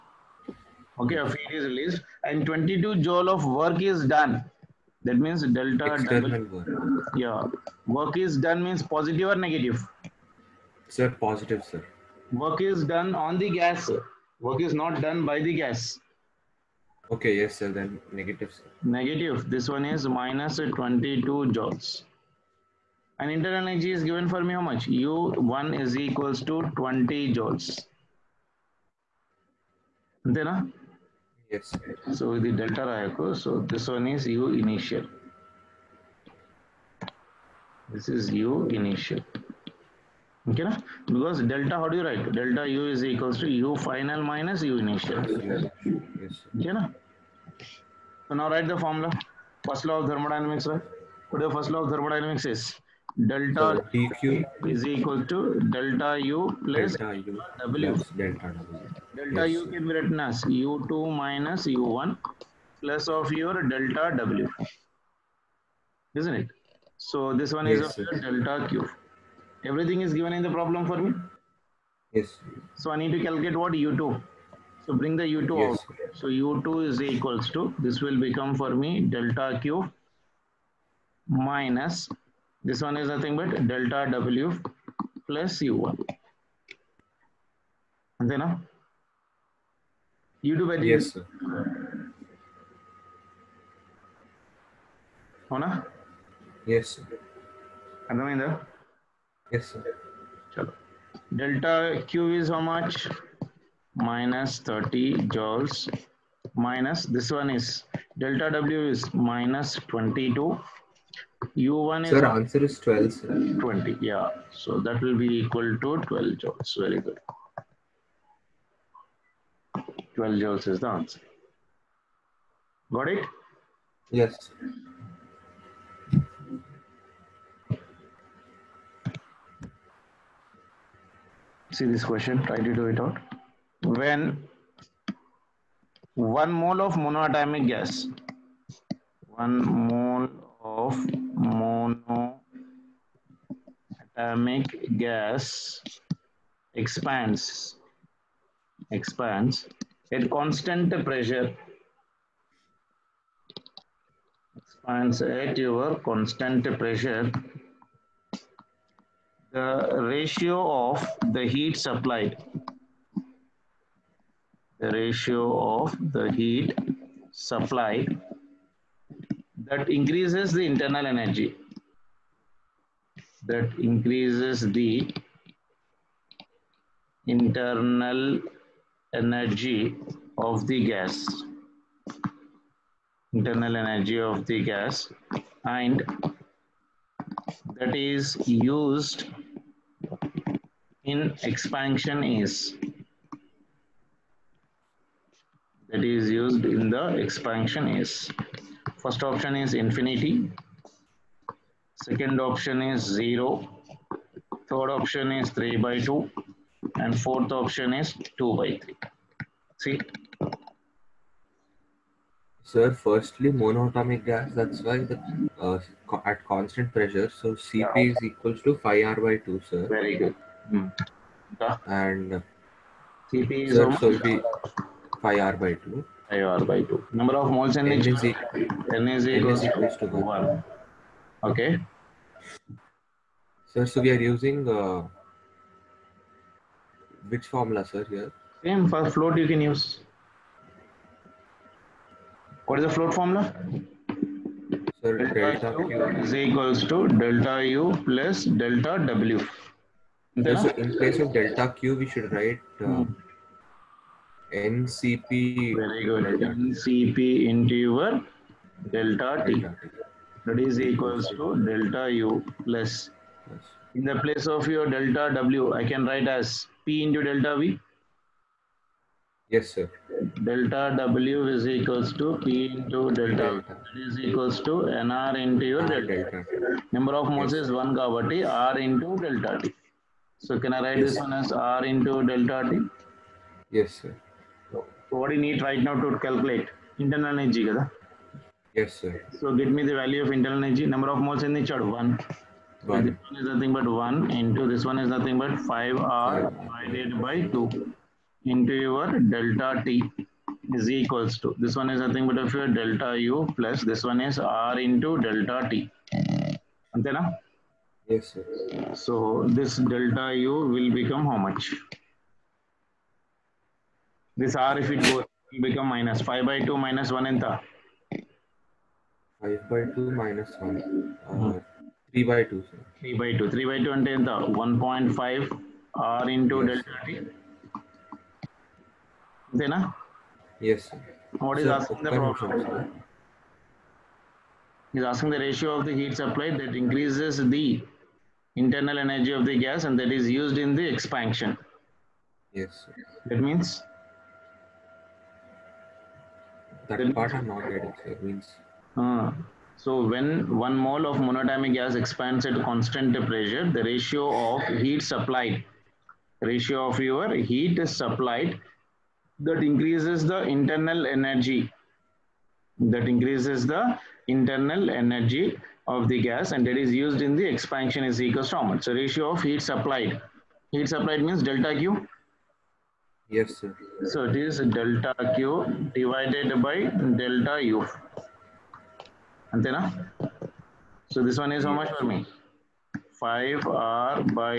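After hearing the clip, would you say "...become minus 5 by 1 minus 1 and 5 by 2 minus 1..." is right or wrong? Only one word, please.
wrong.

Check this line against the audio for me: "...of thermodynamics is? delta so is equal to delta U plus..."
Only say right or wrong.
right.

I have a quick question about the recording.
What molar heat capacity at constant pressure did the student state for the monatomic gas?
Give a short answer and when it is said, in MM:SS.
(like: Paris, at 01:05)
5R/2, at 03:37.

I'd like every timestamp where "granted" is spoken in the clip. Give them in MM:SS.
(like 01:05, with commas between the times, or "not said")
not said.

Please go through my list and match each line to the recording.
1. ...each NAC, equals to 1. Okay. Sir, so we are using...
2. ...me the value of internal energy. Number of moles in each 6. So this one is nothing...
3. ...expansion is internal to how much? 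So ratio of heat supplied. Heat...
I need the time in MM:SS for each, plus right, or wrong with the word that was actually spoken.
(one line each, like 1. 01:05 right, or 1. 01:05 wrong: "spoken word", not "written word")
1. 03:47 right
2. 04:49 wrong: "1", not "6"
3. 06:07 wrong: "equal", not "internal".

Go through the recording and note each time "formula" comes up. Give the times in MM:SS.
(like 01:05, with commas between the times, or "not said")
00:48, 03:57, 04:03.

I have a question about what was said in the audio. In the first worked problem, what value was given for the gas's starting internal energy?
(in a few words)
20 joules.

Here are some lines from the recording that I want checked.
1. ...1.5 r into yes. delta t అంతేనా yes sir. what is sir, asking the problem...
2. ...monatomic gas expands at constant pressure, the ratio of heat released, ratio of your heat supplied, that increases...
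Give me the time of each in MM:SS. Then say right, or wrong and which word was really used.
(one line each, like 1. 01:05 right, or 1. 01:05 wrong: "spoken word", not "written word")
1. 05:24 right
2. 05:51 wrong: "supplied", not "released".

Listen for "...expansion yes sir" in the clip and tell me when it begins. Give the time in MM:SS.
05:40.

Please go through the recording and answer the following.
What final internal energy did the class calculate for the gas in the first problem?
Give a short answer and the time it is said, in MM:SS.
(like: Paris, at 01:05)
12 joules, at 02:00.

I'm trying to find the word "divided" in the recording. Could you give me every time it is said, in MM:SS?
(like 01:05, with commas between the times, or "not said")
04:56, 06:15.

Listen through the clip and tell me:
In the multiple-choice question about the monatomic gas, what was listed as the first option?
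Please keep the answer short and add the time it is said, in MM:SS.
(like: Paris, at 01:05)
infinity, at 03:19.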